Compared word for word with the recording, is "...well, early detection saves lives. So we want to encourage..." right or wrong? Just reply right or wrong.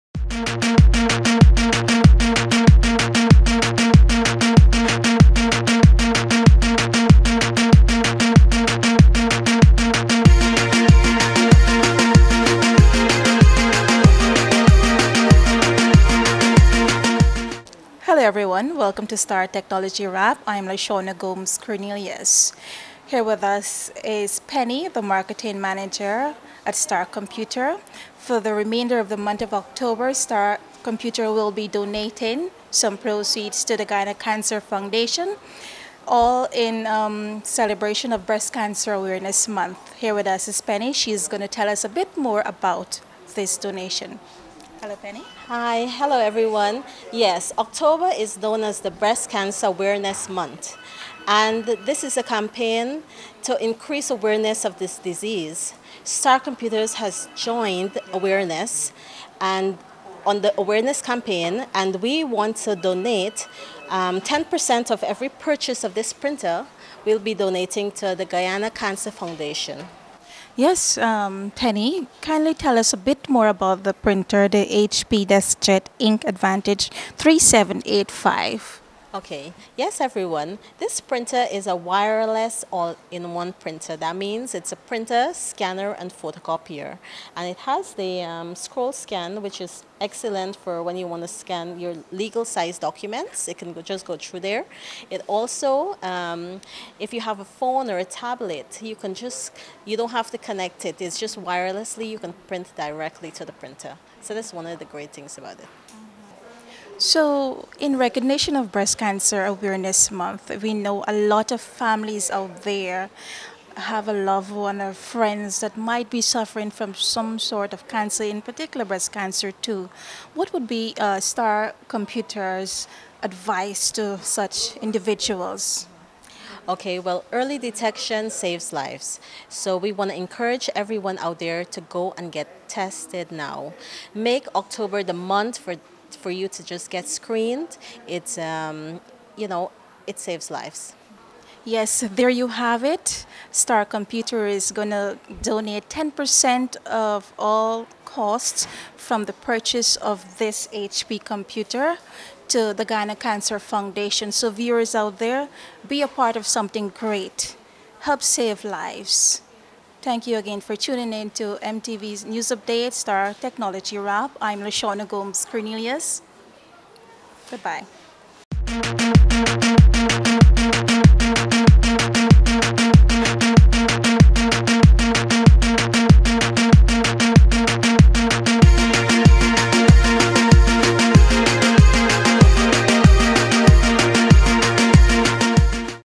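right.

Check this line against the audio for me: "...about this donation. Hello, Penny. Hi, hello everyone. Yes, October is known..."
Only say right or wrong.
right.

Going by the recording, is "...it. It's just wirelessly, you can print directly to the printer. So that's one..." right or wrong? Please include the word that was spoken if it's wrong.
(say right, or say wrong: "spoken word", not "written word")
right.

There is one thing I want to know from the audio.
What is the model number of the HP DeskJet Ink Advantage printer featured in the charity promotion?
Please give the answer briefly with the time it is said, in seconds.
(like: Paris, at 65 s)
3785, at 77 s.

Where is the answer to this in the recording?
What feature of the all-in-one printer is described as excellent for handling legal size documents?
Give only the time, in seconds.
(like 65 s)
88 s.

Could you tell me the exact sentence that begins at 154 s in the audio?
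So viewers out there, be a part of something great.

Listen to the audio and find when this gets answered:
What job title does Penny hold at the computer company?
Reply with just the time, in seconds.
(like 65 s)
25 s.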